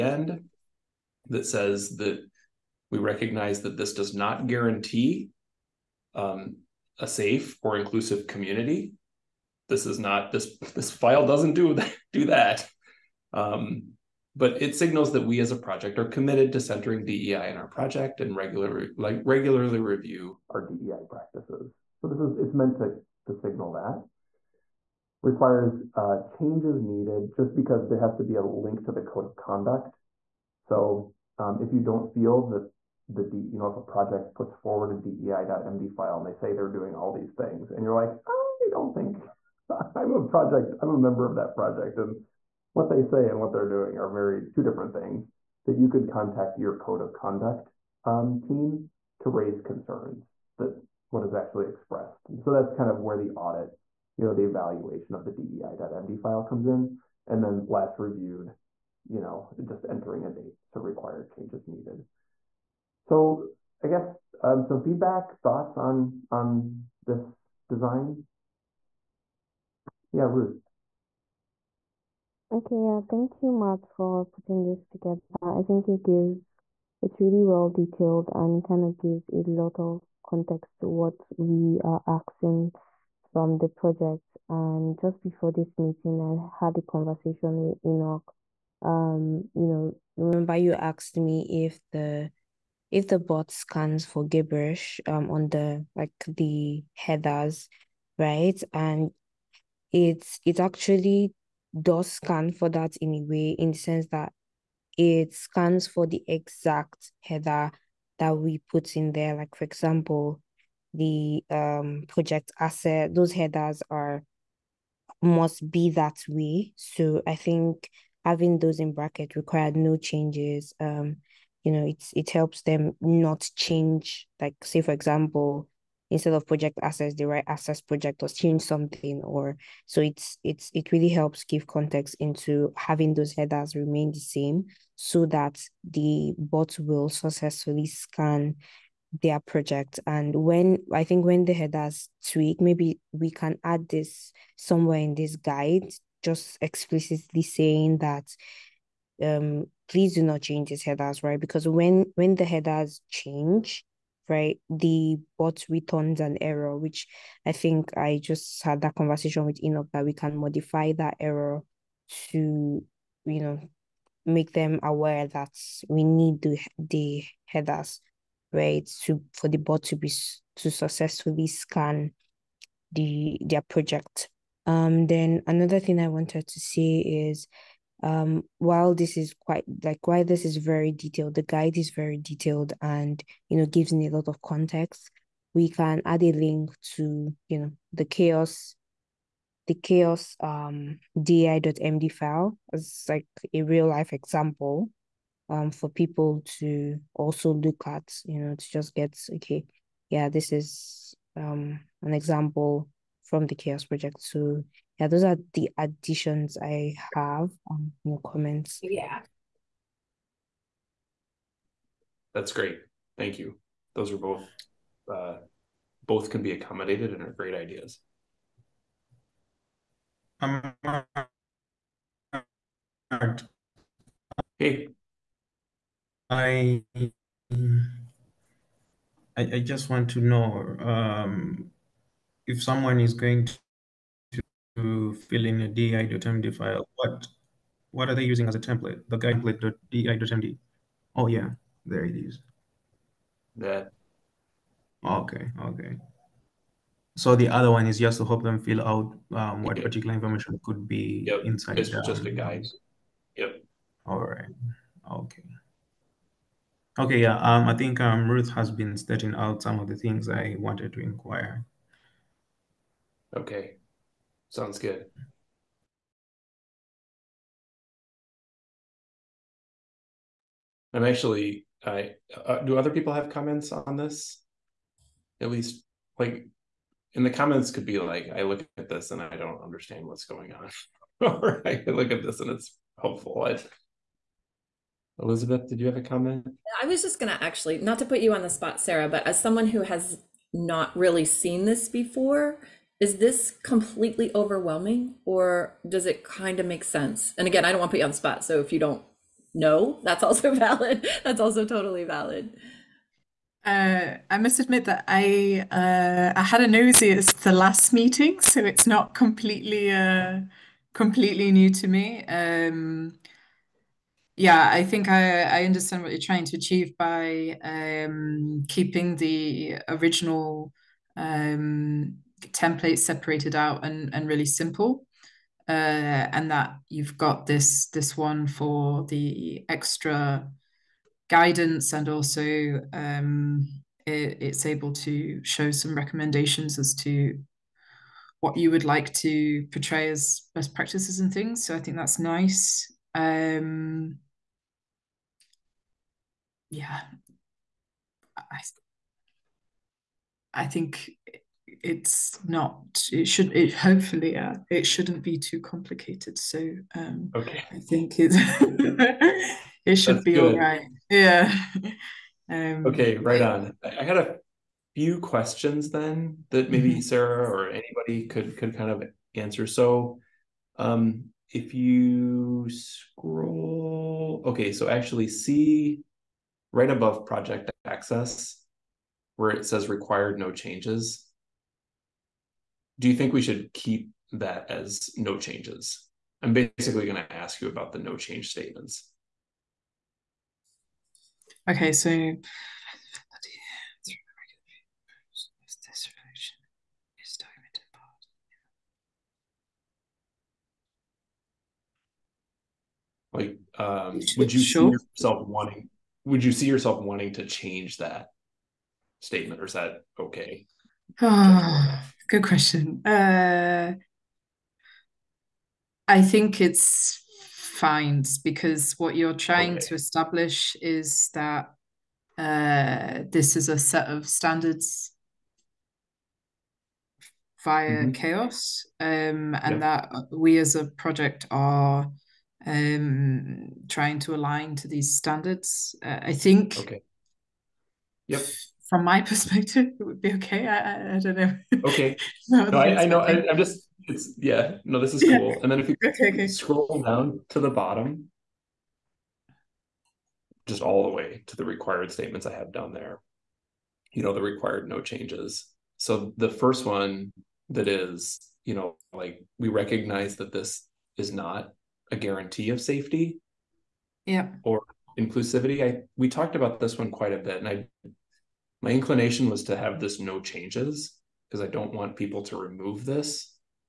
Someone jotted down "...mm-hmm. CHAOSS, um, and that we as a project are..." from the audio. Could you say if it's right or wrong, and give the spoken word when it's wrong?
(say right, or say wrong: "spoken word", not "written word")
right.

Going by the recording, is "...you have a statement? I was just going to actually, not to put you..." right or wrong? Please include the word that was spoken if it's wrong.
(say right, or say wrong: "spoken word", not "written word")
wrong: "comment", not "statement".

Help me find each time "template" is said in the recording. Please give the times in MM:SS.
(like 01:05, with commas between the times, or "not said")
03:58, 05:22.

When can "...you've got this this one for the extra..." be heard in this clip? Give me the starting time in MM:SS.
05:26.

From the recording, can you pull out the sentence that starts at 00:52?
so that's kind of where the audit, you know, the evaluation of the DEI.md file comes in.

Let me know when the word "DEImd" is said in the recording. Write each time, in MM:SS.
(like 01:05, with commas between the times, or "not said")
00:34, 00:55.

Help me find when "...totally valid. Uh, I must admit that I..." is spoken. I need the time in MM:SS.
05:01.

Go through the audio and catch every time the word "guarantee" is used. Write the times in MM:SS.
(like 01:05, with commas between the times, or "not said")
00:04, 07:42.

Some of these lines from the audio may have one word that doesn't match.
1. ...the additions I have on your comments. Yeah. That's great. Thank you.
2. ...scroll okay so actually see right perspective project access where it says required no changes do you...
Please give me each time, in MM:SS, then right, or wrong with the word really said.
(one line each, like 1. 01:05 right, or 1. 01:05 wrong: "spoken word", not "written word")
1. 03:25 right
2. 06:12 wrong: "above", not "perspective".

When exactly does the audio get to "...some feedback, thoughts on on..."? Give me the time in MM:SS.
01:04.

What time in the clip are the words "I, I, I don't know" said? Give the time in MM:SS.
07:20.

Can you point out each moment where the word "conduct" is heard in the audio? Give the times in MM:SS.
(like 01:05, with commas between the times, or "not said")
00:29, 00:47.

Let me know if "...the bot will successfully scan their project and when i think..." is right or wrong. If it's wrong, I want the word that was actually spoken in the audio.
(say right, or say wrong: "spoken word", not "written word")
right.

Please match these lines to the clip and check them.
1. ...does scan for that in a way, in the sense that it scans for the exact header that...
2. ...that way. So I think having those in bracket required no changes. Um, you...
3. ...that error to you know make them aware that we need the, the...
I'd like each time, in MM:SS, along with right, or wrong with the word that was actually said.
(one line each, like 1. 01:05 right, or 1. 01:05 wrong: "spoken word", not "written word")
1. 01:41 right
2. 01:55 right
3. 02:40 right.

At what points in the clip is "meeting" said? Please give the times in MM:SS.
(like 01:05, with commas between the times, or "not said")
01:25, 05:07.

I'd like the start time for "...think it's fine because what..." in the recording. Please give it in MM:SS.
06:56.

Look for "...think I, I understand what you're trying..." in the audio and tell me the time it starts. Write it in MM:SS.
05:14.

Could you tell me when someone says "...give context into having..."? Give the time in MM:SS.
02:11.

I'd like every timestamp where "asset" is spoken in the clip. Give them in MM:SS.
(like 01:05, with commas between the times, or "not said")
01:52.